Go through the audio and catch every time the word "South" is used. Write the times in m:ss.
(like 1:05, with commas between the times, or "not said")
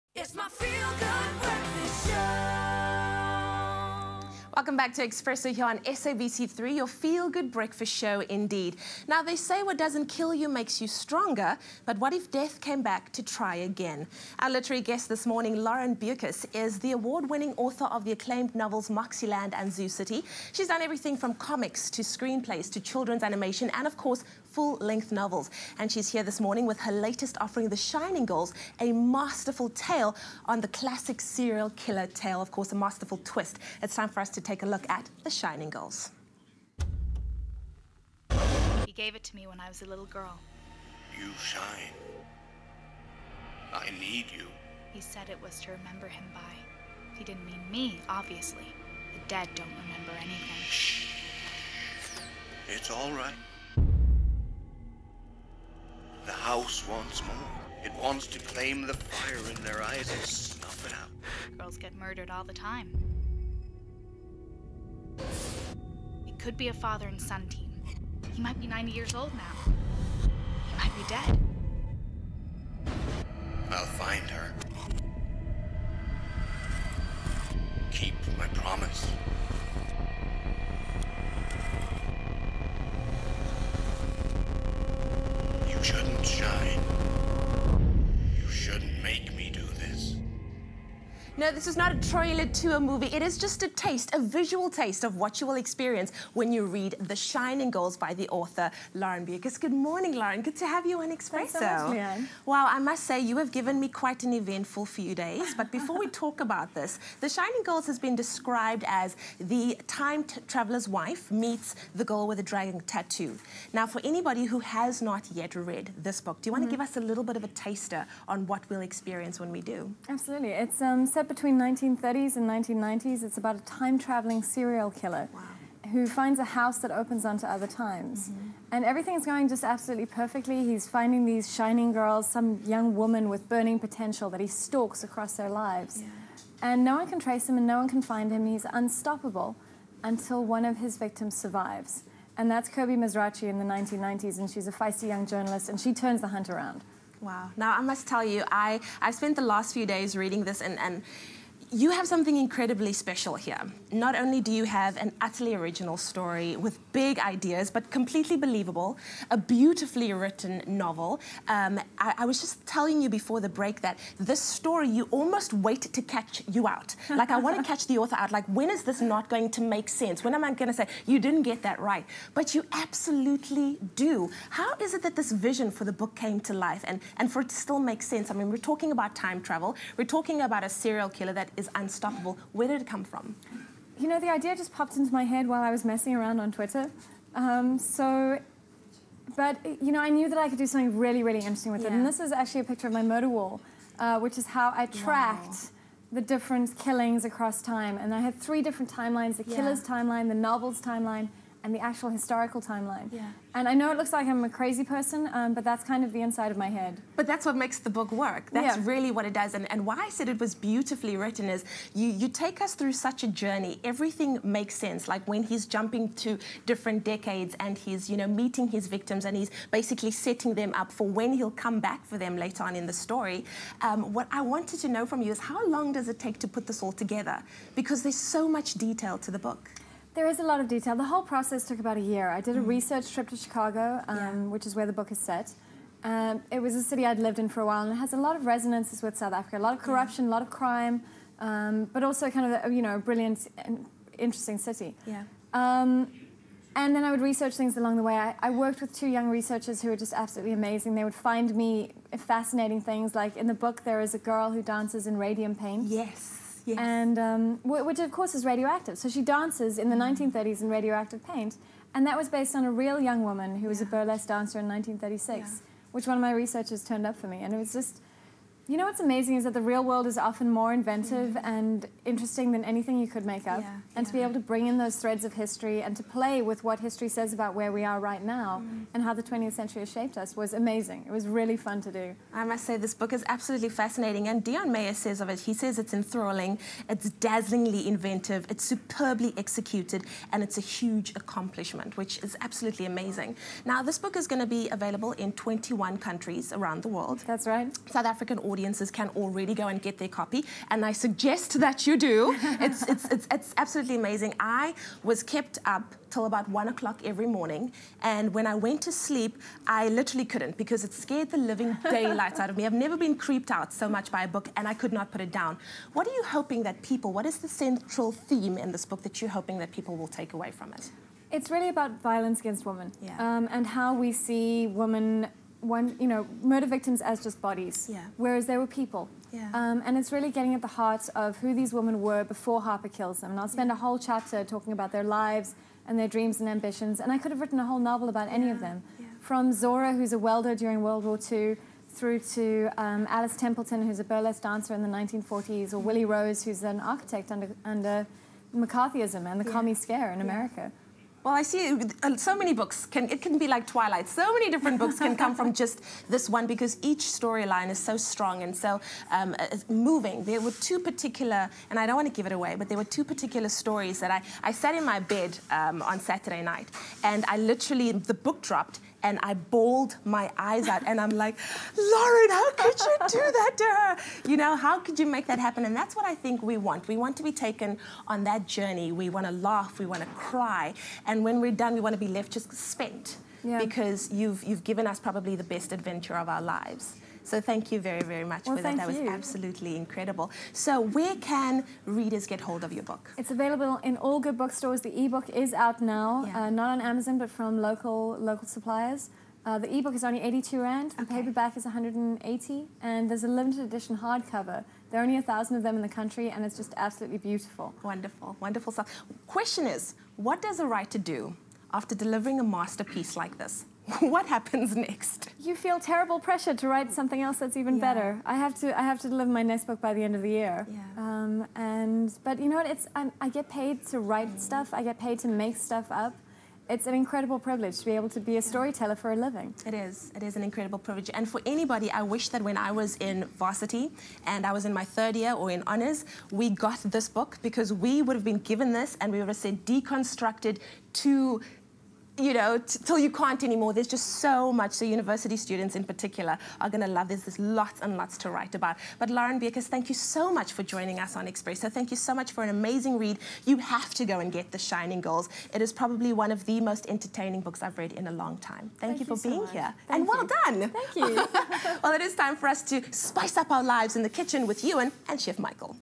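3:59, 4:57.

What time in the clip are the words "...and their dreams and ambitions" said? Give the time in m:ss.
5:35.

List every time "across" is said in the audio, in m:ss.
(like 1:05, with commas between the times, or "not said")
2:15, 3:17.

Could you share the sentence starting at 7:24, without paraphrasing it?
So university students in particular are going to love.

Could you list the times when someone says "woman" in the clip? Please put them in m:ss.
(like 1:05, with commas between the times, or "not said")
2:13, 4:23.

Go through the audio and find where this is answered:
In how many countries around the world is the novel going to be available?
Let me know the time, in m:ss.
4:55.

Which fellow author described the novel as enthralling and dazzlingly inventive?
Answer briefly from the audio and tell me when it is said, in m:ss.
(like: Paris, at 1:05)
Deon Meyer, at 4:44.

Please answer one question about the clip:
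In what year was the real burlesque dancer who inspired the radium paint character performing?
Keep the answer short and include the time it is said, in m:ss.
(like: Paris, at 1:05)
1936, at 4:24.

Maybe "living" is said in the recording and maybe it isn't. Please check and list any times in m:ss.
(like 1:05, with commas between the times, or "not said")
5:11, 7:09.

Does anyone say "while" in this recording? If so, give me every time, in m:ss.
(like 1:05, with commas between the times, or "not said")
3:05, 3:57.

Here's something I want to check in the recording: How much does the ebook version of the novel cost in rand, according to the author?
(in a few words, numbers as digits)
82 rand.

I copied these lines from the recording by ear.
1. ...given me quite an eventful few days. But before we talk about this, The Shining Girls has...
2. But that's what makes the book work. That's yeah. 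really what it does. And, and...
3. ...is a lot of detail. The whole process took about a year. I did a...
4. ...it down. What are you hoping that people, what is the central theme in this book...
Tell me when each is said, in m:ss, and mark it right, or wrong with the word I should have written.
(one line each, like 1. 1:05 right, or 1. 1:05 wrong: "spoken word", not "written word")
1. 1:43 right
2. 3:27 right
3. 3:50 right
4. 5:15 right.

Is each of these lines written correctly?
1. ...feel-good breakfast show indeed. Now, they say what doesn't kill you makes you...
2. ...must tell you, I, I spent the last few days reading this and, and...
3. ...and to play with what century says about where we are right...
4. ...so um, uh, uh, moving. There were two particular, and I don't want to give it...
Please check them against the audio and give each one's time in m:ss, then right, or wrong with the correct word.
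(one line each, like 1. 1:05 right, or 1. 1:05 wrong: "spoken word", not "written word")
1. 0:06 right
2. 2:27 right
3. 4:35 wrong: "history", not "century"
4. 5:58 right.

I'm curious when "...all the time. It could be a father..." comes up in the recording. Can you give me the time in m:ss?
1:02.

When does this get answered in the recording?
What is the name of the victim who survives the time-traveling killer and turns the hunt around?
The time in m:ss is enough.
2:22.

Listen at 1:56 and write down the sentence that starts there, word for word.
give us a little bit of a taster on what we'll experience when we do?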